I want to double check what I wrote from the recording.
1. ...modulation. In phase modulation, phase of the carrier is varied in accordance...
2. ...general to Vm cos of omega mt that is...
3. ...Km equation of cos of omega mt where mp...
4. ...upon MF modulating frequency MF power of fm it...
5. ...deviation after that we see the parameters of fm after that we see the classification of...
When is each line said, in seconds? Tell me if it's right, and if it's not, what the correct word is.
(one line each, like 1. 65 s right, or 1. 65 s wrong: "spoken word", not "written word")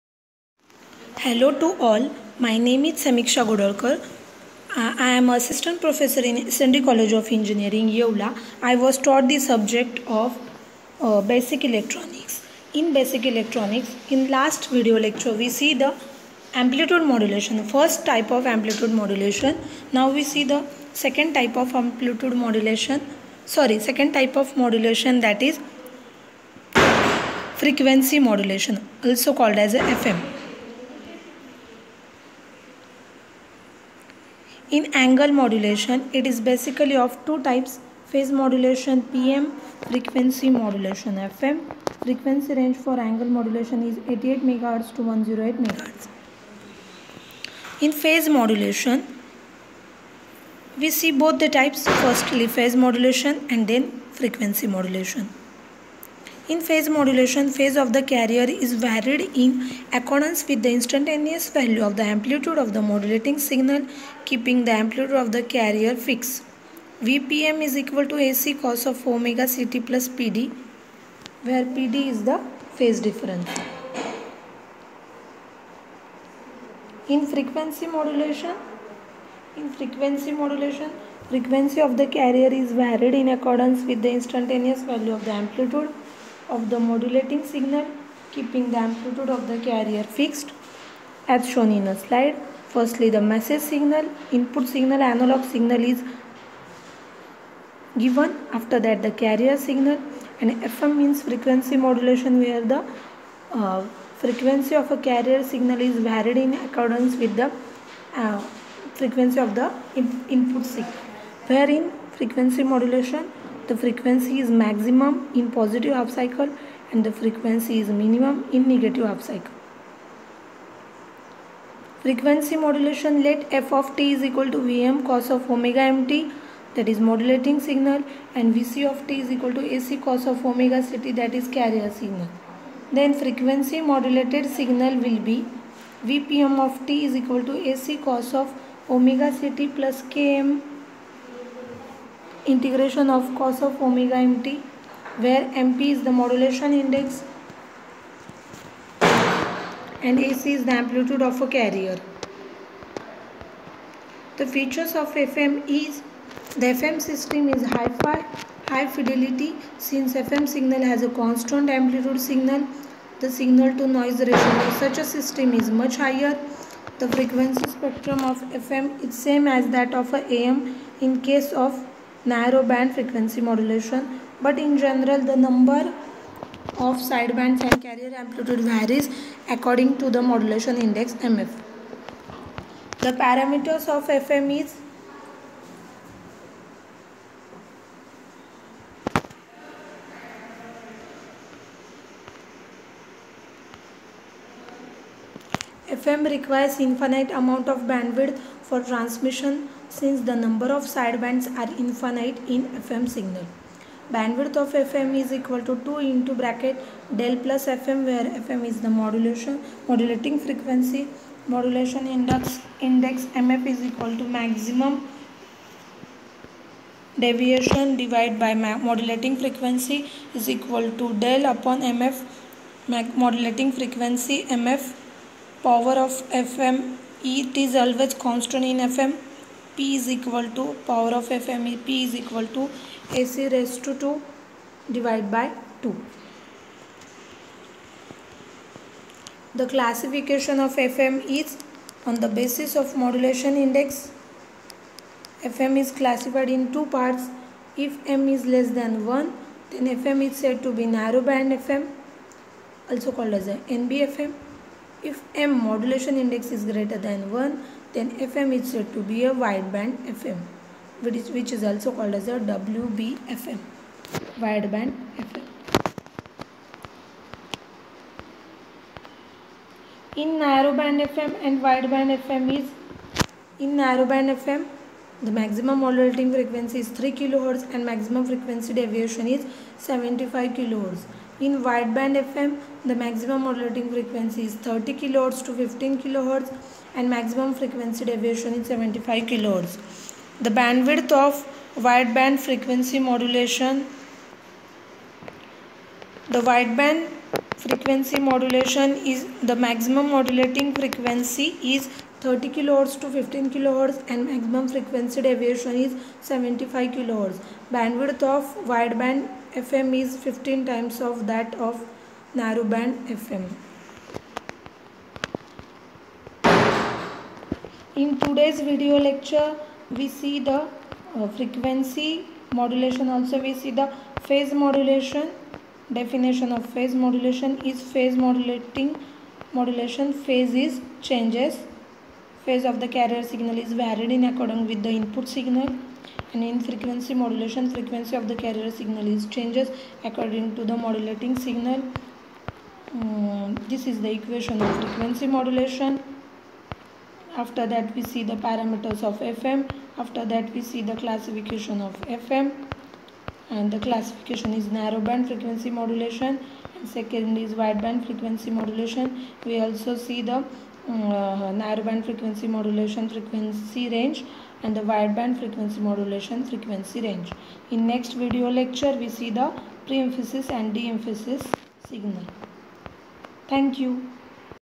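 1. 54 s right
2. 124 s wrong: "equal", not "general"
3. 140 s wrong: "integration", not "equation"
4. 221 s right
5. 345 s wrong: "modulation", not "deviation".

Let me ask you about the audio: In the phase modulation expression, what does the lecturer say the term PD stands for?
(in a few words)
phase difference.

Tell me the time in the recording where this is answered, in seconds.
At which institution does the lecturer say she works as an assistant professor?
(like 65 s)
6 s.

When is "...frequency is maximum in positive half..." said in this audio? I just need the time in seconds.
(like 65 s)
113 s.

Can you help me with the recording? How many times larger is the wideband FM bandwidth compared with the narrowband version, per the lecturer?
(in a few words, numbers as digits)
15.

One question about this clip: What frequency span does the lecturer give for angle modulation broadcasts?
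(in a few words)
88 MHz to 108 MHz.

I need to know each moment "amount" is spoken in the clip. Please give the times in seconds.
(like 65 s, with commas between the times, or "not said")
197 s.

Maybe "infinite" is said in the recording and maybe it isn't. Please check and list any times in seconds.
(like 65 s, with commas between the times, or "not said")
196 s, 201 s.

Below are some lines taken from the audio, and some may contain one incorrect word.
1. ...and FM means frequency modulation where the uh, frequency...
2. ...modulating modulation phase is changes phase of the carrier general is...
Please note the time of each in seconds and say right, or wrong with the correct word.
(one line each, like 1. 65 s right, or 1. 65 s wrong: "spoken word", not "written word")
1. 100 s right
2. 328 s wrong: "signal", not "general".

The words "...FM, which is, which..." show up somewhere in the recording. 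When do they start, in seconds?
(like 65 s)
260 s.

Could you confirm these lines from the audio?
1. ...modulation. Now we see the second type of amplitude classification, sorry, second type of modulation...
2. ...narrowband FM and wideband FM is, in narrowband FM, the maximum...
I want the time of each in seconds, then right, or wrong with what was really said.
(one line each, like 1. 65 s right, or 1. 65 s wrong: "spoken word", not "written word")
1. 19 s wrong: "modulation", not "classification"
2. 270 s right.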